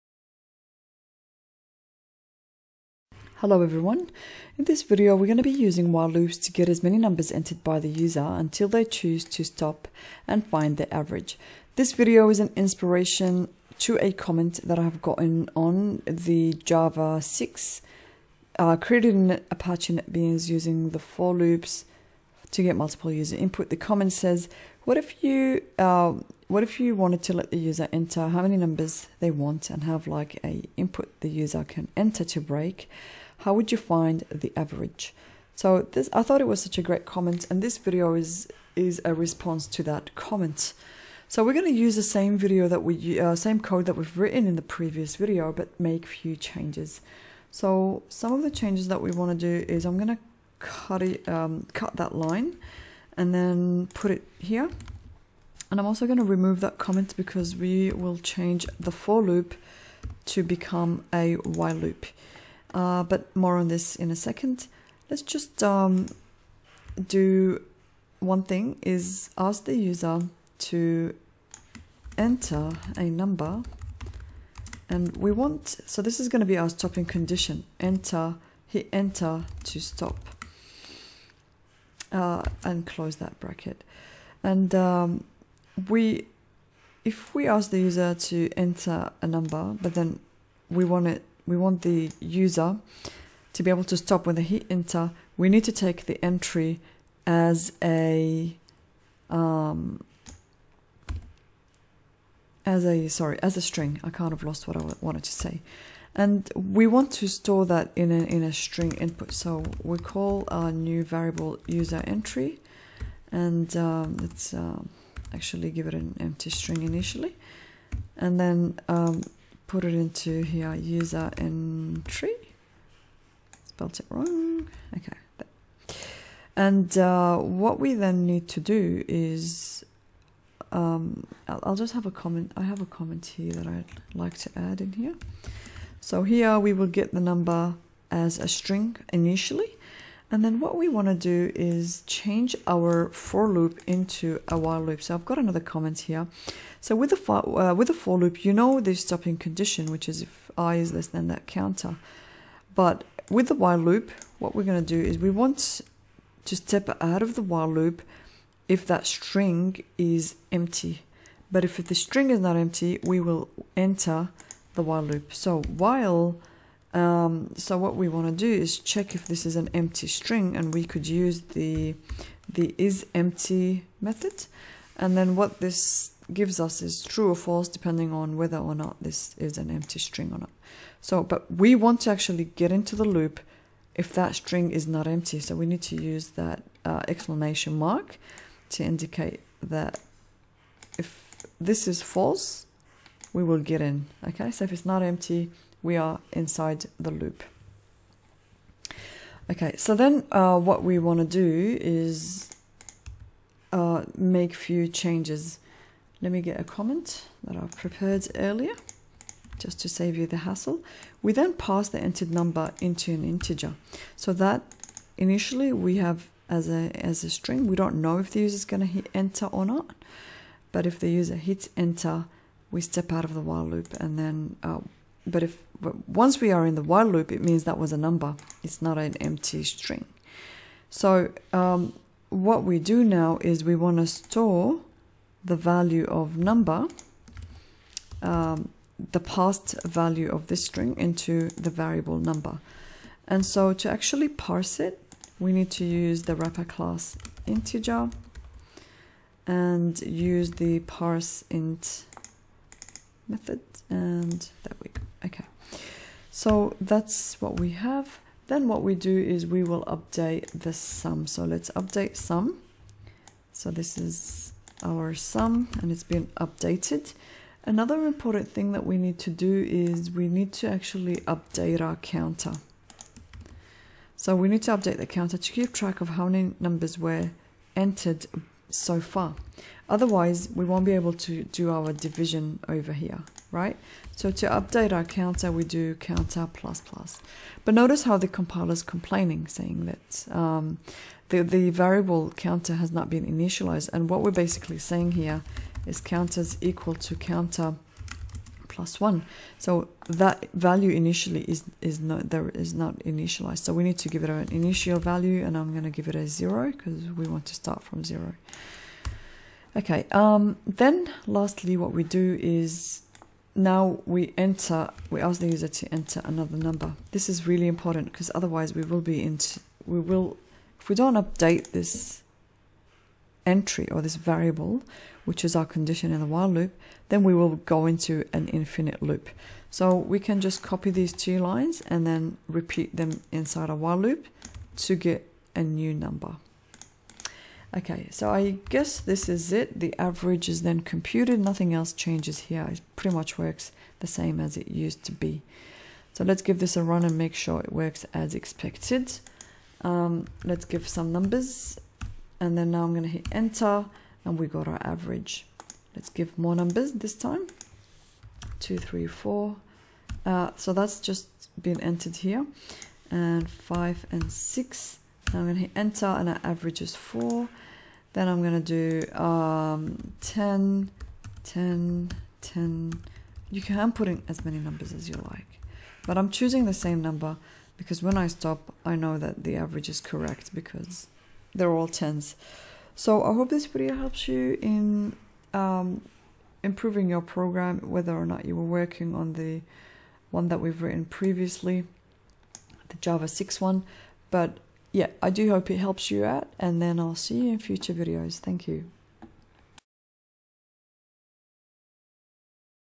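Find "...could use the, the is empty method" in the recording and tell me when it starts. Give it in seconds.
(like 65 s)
170 s.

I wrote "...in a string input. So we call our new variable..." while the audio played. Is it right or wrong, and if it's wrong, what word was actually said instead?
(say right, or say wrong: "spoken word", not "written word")
right.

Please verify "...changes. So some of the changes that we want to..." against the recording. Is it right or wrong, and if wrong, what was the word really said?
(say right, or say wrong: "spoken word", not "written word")
right.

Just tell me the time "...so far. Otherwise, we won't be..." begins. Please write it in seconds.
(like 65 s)
278 s.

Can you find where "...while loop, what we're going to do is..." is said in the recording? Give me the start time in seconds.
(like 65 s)
153 s.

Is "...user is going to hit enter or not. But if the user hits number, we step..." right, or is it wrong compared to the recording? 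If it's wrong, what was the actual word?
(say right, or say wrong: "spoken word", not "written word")
wrong: "enter", not "number".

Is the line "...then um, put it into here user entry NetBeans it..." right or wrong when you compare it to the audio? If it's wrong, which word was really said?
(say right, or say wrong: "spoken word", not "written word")
wrong: "Spelt", not "NetBeans".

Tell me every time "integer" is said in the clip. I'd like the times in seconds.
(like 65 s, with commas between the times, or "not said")
213 s, 247 s.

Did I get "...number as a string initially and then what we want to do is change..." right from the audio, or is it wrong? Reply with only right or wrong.
right.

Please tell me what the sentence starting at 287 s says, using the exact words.
But notice how the compiler is complaining, saying that um, the, the variable counter has not been initialized.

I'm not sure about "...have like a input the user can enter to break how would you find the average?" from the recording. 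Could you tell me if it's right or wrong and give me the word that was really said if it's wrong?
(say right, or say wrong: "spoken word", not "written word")
right.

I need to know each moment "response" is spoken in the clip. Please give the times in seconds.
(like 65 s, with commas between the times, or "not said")
39 s.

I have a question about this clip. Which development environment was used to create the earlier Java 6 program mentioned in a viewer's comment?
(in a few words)
Apache NetBeans.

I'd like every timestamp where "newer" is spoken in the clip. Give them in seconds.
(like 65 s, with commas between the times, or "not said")
not said.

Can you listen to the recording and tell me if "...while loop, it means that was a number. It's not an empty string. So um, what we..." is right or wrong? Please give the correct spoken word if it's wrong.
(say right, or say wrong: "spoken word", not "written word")
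right.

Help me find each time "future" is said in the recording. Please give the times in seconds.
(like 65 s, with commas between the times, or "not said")
397 s.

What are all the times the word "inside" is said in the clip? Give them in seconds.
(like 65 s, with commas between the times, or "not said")
196 s, 333 s.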